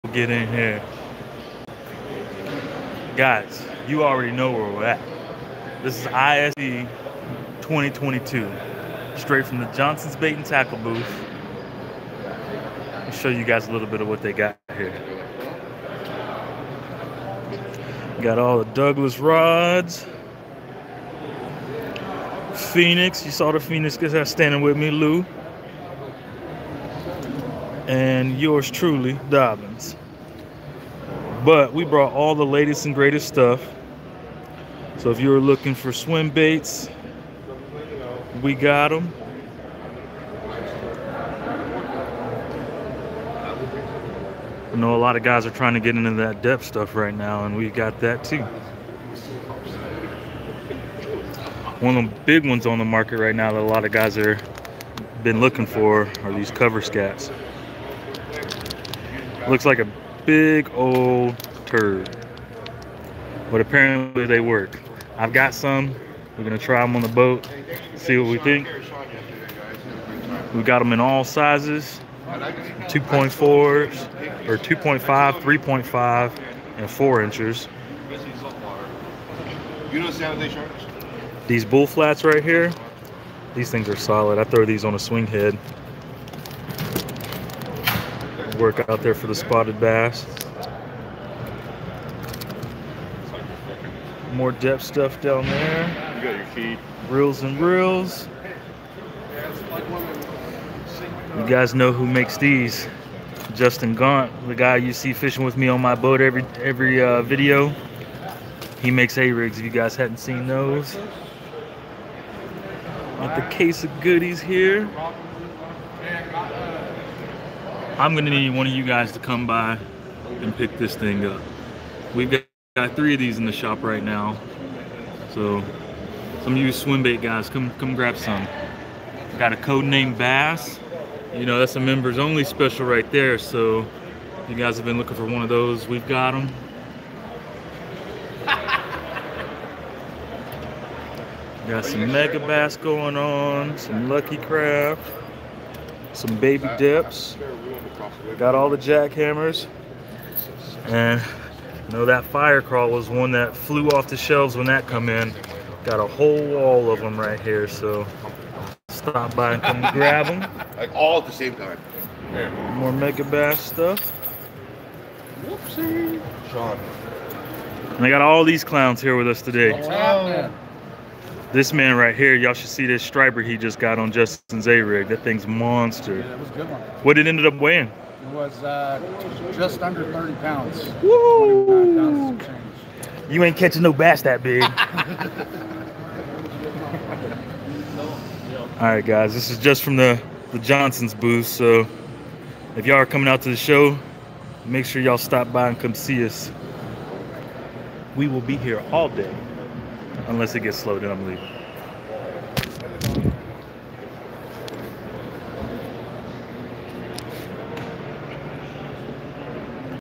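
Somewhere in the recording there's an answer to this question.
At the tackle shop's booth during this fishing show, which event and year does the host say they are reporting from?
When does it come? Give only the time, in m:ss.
0:06.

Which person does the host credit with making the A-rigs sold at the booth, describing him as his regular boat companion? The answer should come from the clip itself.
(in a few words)
Justin Gaunt.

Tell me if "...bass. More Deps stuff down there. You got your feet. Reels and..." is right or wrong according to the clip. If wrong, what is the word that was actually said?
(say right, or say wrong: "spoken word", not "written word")
right.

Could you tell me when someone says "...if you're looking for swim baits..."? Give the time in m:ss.
0:35.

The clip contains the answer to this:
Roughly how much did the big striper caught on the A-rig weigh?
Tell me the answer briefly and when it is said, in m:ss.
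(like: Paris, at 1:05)
just under 30 pounds, at 2:59.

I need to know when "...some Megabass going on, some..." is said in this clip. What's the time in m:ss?
2:21.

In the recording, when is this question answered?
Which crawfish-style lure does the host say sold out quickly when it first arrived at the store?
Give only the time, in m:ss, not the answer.
2:32.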